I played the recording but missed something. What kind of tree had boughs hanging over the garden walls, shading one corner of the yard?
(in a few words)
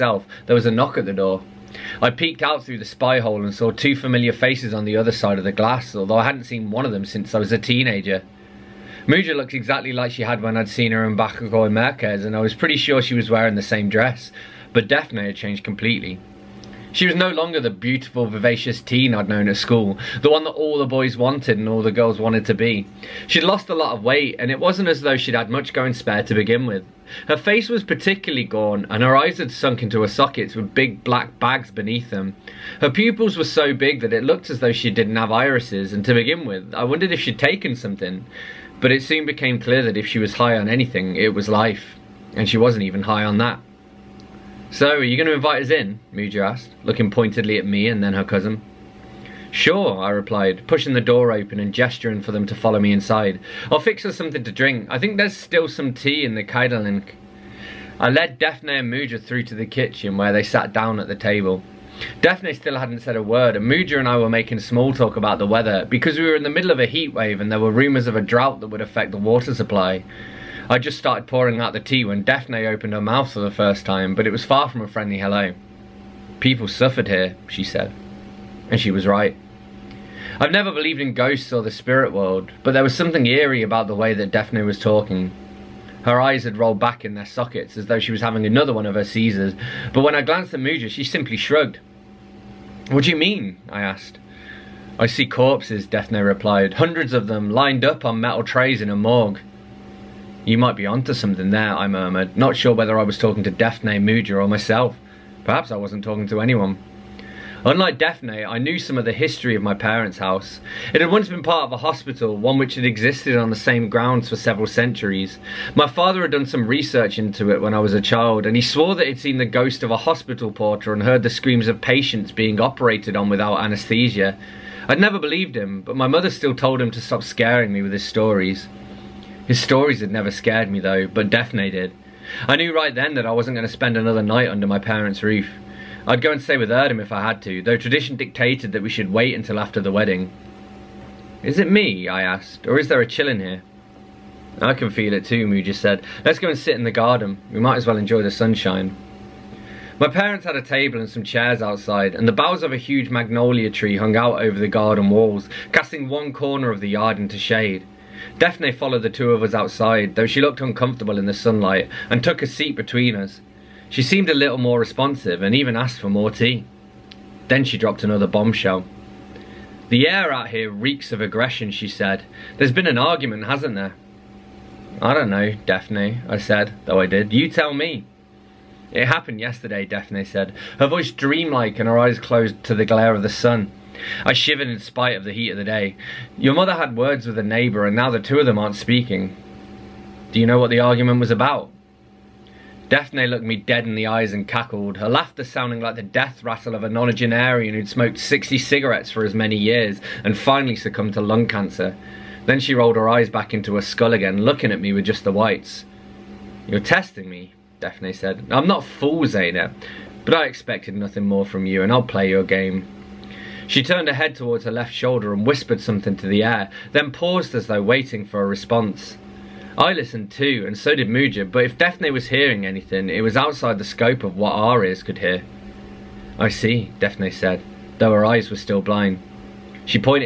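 magnolia.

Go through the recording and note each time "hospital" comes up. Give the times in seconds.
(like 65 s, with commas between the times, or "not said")
111 s, 119 s.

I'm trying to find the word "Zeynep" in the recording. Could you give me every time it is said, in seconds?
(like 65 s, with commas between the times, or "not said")
209 s.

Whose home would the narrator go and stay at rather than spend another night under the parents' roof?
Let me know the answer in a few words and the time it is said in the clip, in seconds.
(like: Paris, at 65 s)
Erdem, at 136 s.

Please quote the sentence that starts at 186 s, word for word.
Your mother had words with a neighbour and now the two of them aren't speaking.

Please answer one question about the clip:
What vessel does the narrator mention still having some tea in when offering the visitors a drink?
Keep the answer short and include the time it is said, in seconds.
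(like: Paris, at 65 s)
çaydanlık, at 56 s.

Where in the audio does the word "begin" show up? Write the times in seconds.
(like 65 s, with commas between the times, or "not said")
26 s, 36 s.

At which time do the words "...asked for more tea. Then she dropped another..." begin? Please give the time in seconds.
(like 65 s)
165 s.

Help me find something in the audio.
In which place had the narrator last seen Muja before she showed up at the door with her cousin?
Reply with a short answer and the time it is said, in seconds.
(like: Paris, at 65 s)
Bakugo in Merkez, at 11 s.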